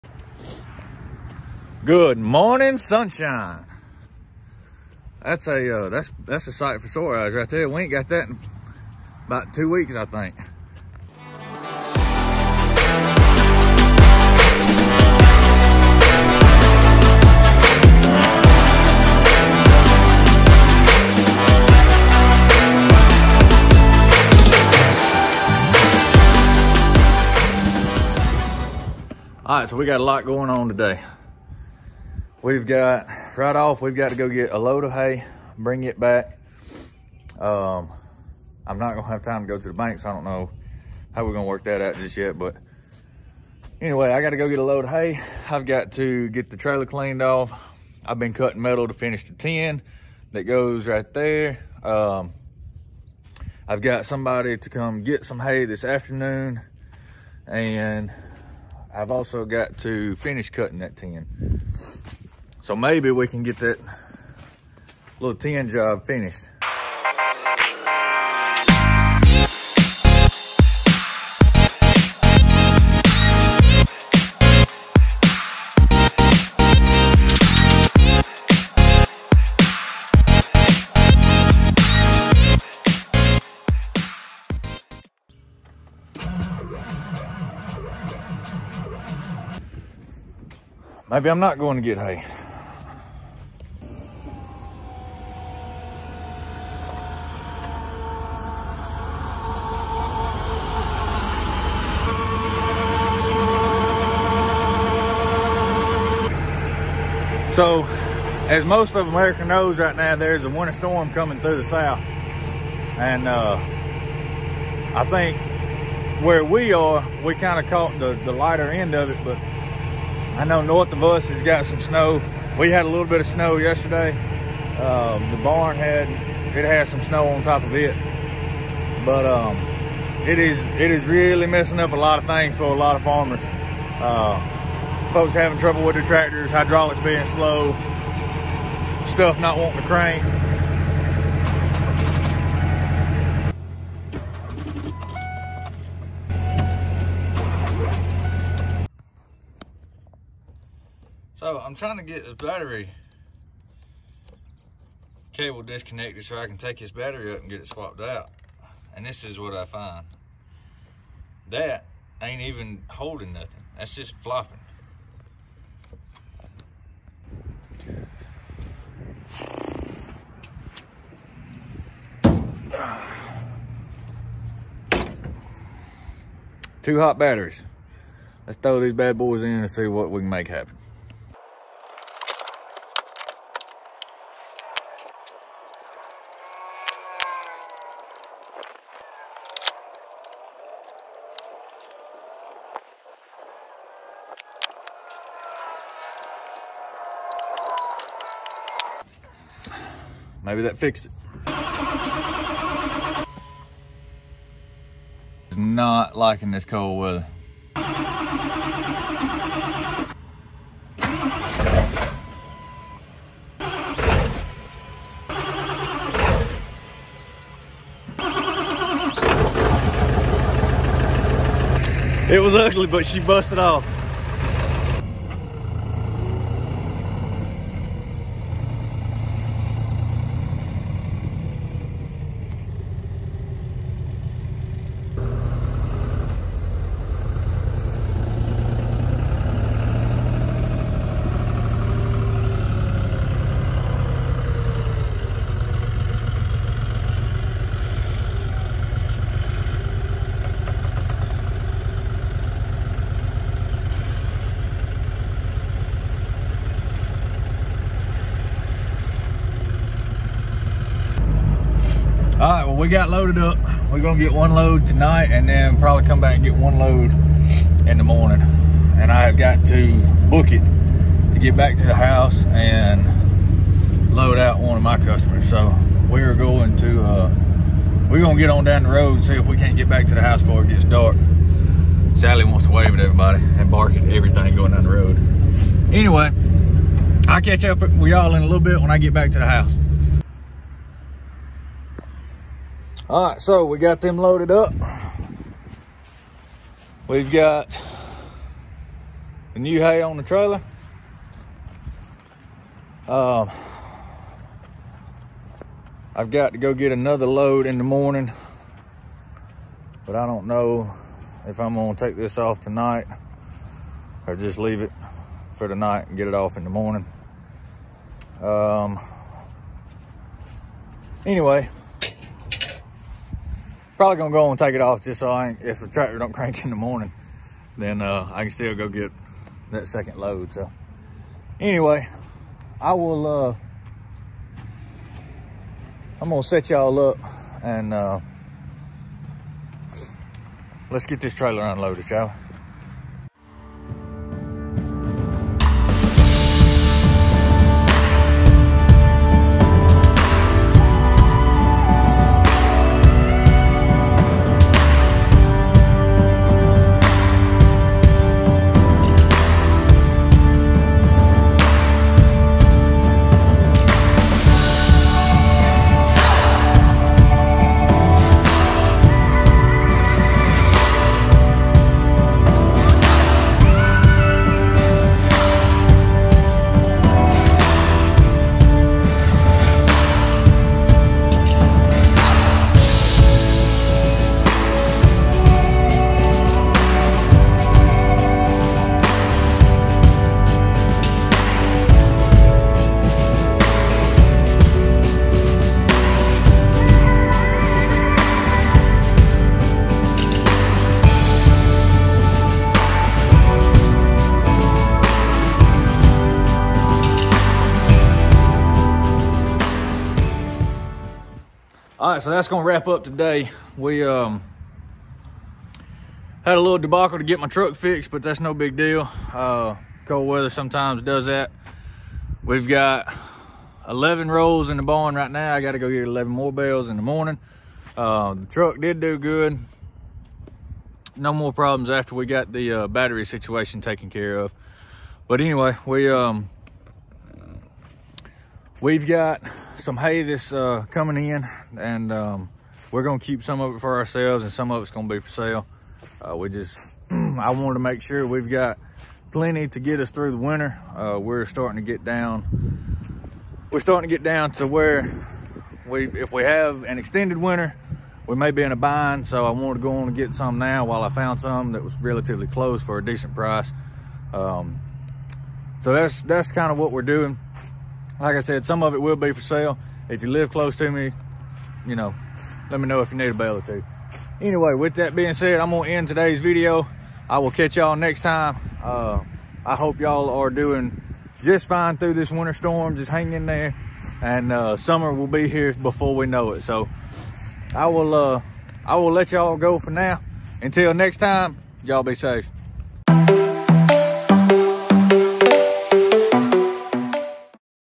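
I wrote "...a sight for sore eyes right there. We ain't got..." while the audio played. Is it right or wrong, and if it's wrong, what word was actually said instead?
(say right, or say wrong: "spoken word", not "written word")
right.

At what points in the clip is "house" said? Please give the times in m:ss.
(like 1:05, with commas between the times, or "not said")
4:31, 4:40, 4:49.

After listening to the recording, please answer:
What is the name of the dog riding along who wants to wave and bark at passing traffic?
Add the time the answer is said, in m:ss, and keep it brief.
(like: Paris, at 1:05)
Sally, at 4:42.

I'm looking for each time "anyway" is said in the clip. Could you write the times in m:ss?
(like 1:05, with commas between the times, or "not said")
0:43, 4:45, 5:21, 5:31, 7:15, 7:54.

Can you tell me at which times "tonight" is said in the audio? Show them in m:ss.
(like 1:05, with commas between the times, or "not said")
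4:24, 5:12.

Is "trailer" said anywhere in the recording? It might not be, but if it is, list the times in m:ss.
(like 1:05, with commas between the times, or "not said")
0:46, 5:00, 5:41.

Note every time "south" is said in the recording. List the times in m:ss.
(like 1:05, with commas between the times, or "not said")
1:51.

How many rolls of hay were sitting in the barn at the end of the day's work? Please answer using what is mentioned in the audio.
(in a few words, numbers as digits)
11.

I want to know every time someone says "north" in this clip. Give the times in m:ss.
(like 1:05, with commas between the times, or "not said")
2:00.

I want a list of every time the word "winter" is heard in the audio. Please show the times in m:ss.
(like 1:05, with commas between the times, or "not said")
1:50, 7:30, 7:37, 8:02.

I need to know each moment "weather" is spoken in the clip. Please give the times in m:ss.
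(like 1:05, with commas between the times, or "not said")
3:26, 7:00.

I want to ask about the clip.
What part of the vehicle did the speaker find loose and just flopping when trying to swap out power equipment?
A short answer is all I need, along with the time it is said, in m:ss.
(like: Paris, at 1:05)
battery cable, at 2:32.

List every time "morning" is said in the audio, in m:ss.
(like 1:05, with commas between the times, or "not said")
0:02, 4:28, 5:07, 5:16, 5:26, 7:07.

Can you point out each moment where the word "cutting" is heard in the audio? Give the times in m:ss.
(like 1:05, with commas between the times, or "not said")
0:48, 1:00.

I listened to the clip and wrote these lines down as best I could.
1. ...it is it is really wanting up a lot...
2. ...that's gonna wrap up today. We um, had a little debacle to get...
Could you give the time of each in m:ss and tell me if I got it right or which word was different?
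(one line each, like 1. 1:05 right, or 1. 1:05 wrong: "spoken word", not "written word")
1. 2:10 wrong: "messing", not "wanting"
2. 6:52 right.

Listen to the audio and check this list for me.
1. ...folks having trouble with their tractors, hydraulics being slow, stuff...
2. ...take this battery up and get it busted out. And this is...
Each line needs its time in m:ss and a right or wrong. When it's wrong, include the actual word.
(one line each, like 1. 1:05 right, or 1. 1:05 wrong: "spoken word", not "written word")
1. 2:15 right
2. 2:36 wrong: "swapped", not "busted".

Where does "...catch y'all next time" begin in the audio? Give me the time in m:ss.
7:57.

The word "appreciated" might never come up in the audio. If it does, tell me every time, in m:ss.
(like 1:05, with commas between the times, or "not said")
not said.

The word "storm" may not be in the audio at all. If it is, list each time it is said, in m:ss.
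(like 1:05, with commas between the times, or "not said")
1:50, 8:02.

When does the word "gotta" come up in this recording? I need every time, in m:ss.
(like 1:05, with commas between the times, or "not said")
0:44, 7:05.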